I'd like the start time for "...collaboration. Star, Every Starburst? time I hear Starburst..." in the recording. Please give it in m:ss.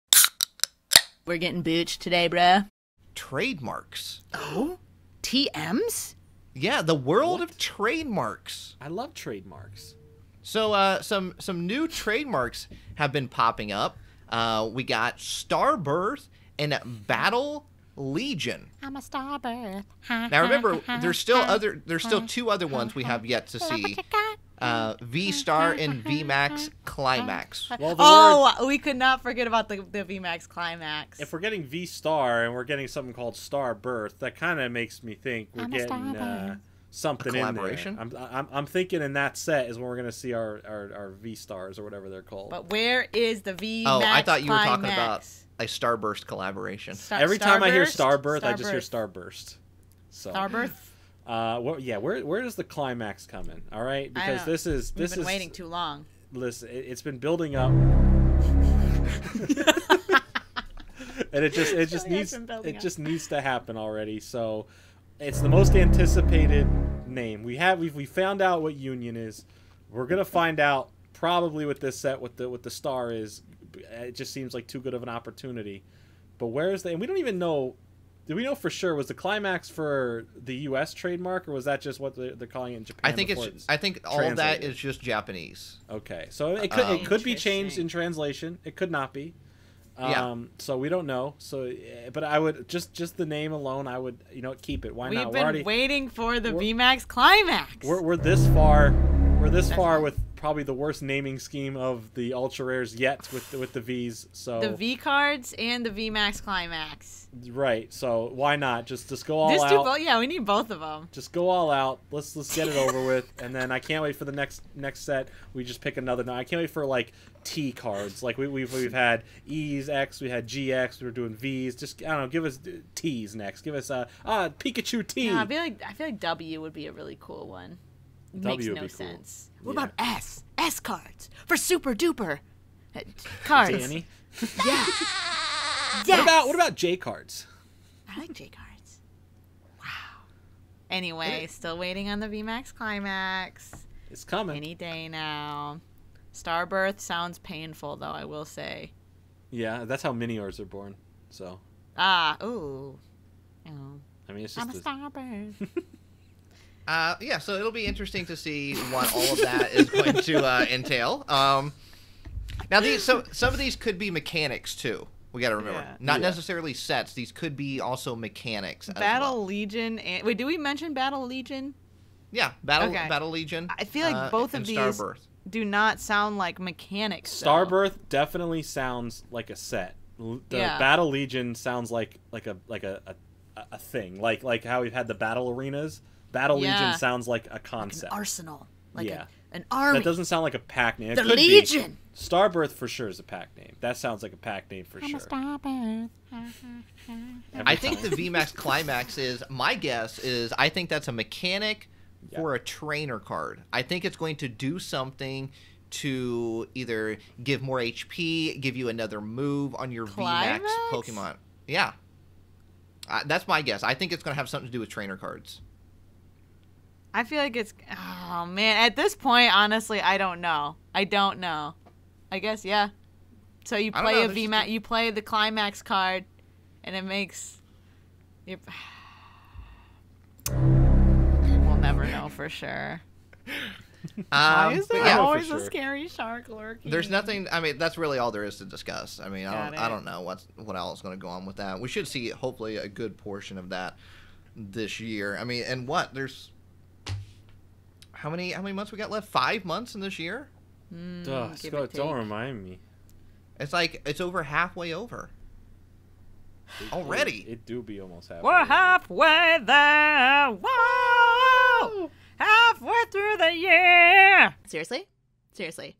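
0:46.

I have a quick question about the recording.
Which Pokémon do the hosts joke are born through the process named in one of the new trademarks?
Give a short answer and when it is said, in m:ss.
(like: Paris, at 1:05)
Miniors, at 2:30.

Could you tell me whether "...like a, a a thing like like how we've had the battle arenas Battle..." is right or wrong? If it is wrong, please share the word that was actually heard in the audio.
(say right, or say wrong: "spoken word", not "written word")
right.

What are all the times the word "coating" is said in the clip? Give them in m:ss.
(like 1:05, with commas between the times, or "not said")
not said.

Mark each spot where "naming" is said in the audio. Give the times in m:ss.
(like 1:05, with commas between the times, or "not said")
1:41.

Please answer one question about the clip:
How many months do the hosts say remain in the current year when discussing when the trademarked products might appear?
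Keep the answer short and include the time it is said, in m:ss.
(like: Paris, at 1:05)
5, at 4:09.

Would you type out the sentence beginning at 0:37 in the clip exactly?
I'm, I'm, I'm, thinking in that set is when we're going to see our, our, our, V Stars or whatever they're called.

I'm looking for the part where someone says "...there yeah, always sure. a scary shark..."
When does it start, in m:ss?
3:54.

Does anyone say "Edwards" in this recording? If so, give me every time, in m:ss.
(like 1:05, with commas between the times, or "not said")
not said.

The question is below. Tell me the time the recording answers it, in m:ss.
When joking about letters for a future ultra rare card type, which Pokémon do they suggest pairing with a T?
2:04.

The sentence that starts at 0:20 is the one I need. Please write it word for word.
now remember, there's still other there's still two other ones we have yet to see uh, V Star and V Max Climax.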